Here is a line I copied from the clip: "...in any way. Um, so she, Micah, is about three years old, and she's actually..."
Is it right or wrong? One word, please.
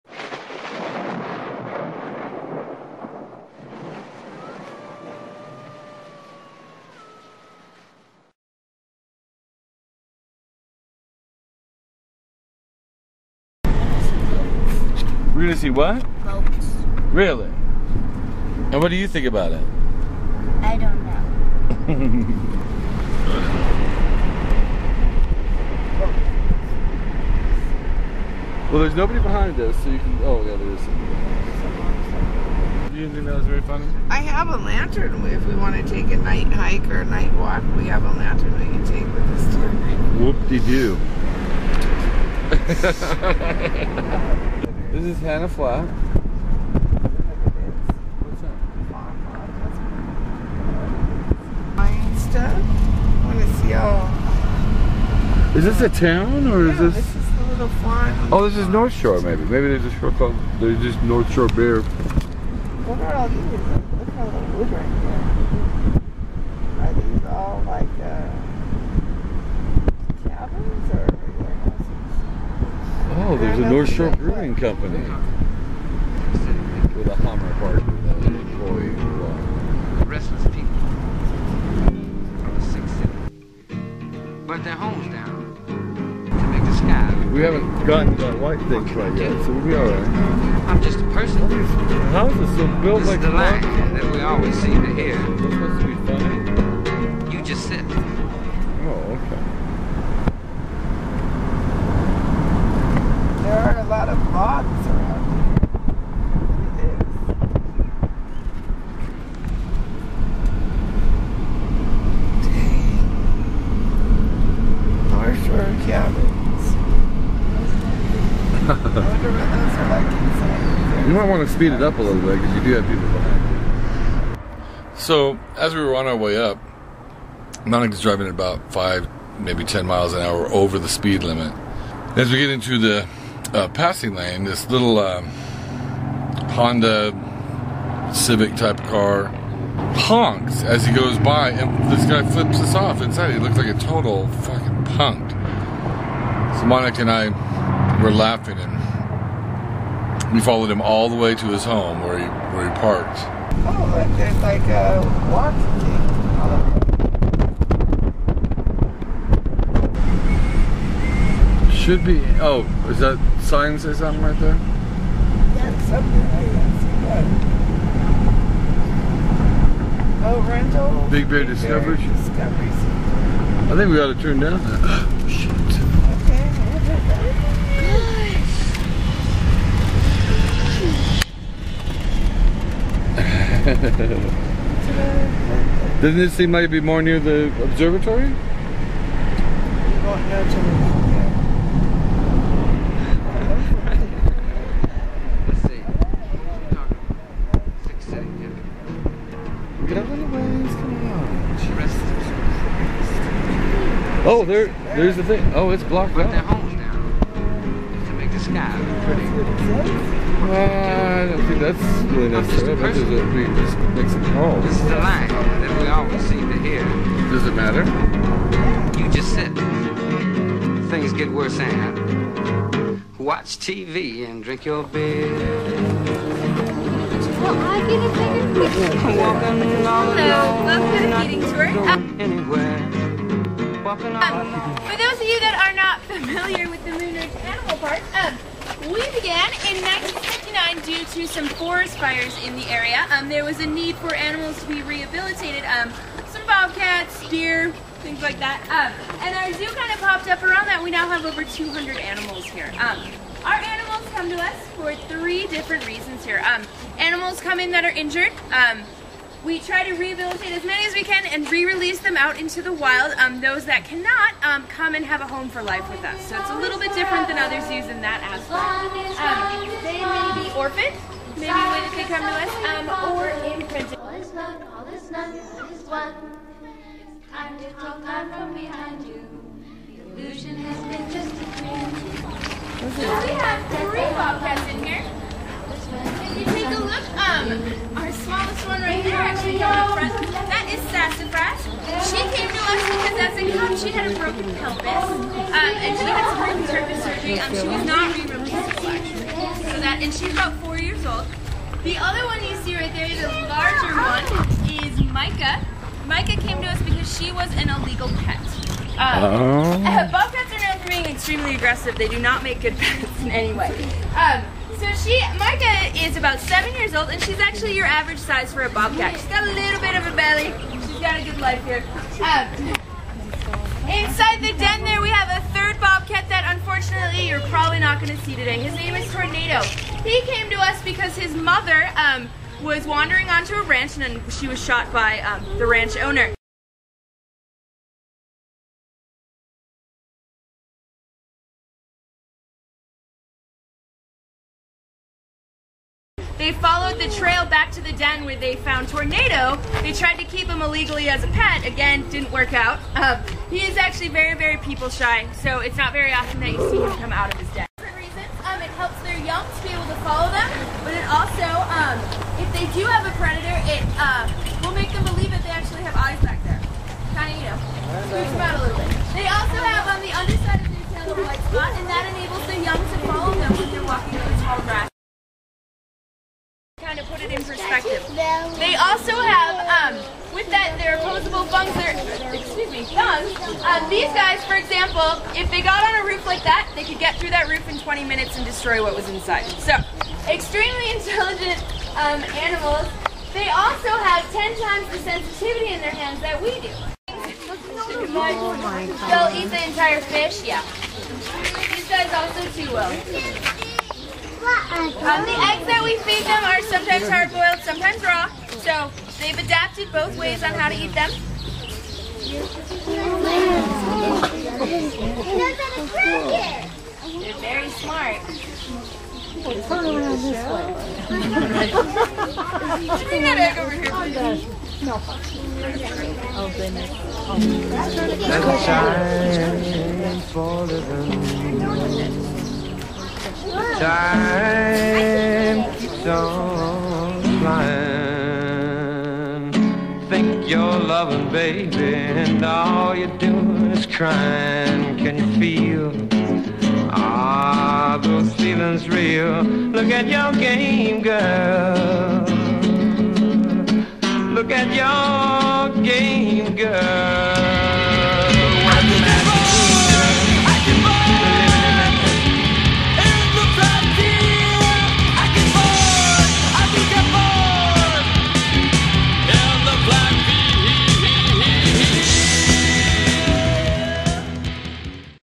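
wrong.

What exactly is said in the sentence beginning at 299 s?
So that, and she's about four years old.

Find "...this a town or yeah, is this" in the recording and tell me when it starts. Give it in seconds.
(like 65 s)
55 s.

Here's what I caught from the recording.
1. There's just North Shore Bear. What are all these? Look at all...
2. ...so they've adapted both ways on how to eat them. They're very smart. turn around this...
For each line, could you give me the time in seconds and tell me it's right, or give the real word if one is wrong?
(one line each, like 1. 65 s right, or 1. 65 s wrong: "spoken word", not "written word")
1. 60 s right
2. 408 s right.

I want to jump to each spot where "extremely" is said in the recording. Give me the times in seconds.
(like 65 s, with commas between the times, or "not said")
311 s, 390 s.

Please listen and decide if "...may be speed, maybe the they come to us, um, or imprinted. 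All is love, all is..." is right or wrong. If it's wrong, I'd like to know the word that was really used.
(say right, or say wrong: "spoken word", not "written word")
wrong: "orphaned", not "speed".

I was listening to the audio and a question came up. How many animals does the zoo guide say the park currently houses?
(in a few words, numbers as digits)
Over 200.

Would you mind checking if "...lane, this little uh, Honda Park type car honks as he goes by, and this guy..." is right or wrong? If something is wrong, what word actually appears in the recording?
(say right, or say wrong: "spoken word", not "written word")
wrong: "Civic", not "Park".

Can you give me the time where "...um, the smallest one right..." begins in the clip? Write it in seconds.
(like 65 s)
287 s.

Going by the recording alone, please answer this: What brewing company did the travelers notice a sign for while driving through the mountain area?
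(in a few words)
North Shore Brewing Company.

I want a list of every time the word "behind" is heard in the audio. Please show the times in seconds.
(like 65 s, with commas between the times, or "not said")
29 s, 123 s, 278 s.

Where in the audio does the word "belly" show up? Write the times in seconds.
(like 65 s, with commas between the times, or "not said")
320 s.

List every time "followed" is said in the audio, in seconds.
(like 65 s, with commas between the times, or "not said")
150 s, 346 s.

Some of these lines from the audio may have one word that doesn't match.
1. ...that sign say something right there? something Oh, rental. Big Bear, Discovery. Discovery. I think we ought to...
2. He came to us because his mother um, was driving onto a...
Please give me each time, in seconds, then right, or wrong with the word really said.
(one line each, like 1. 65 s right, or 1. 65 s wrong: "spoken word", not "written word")
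1. 162 s right
2. 330 s wrong: "wandering", not "driving".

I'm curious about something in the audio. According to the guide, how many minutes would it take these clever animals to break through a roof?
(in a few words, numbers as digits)
20 minutes.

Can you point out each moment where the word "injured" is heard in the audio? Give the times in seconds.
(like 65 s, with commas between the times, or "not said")
257 s.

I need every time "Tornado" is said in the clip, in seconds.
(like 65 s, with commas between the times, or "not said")
329 s, 348 s.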